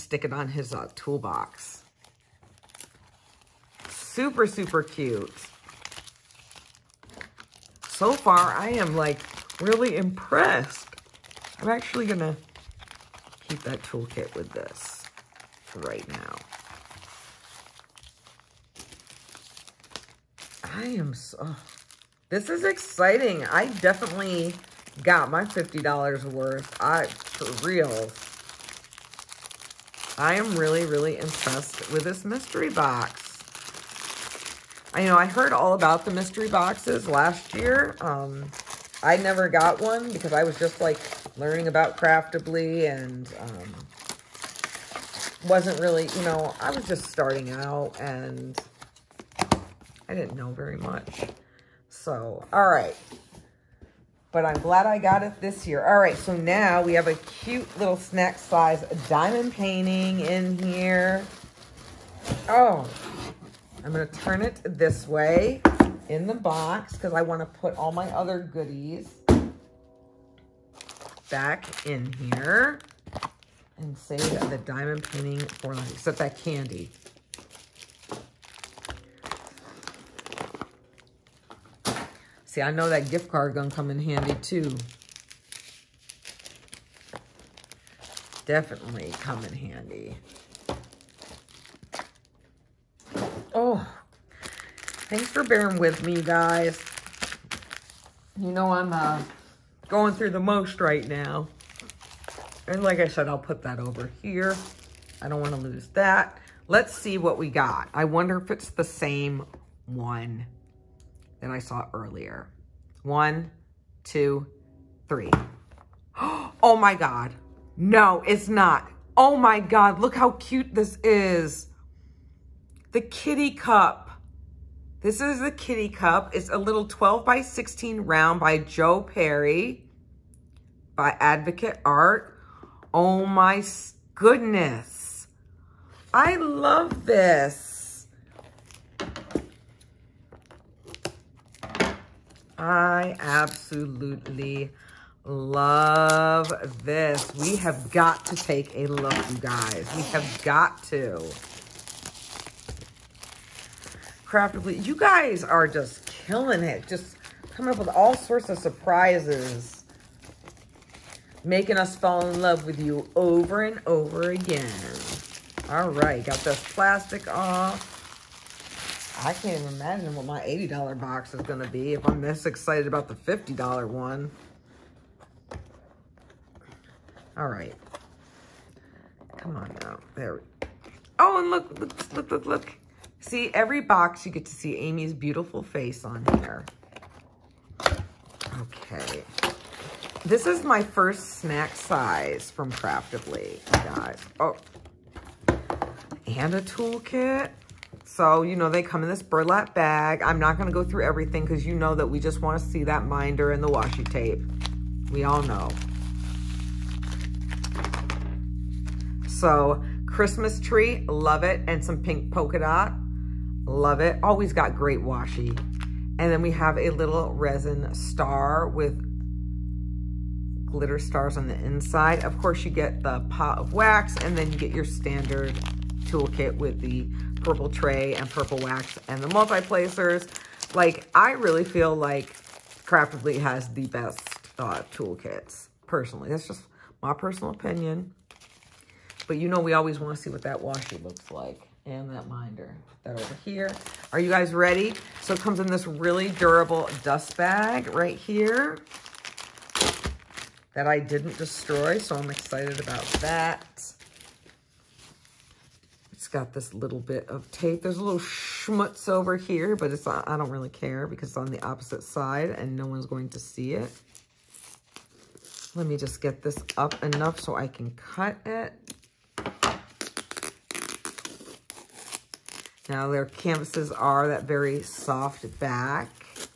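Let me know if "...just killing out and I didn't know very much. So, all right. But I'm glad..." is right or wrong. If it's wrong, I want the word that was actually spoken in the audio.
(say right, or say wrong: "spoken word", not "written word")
wrong: "starting", not "killing".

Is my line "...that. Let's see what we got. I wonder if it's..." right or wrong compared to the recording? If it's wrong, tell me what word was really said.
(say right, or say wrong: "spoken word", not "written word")
right.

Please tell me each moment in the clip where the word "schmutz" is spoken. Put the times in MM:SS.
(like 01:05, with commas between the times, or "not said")
04:18.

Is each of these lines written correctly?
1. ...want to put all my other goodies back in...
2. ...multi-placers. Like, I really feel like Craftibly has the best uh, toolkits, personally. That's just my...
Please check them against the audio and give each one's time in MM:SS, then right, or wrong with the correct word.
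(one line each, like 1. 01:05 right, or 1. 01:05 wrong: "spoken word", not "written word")
1. 01:07 right
2. 03:49 right.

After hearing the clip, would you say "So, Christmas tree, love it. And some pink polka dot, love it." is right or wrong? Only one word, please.
right.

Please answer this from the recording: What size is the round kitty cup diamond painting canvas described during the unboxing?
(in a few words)
12 by 16.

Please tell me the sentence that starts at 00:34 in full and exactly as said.
I know I heard all about the mystery boxes last year.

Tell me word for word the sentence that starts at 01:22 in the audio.
See, I know that gift card gonna come in handy too.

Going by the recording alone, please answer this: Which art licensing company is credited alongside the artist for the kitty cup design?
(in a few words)
Advocate Art.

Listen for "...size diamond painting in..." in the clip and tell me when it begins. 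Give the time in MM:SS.
00:58.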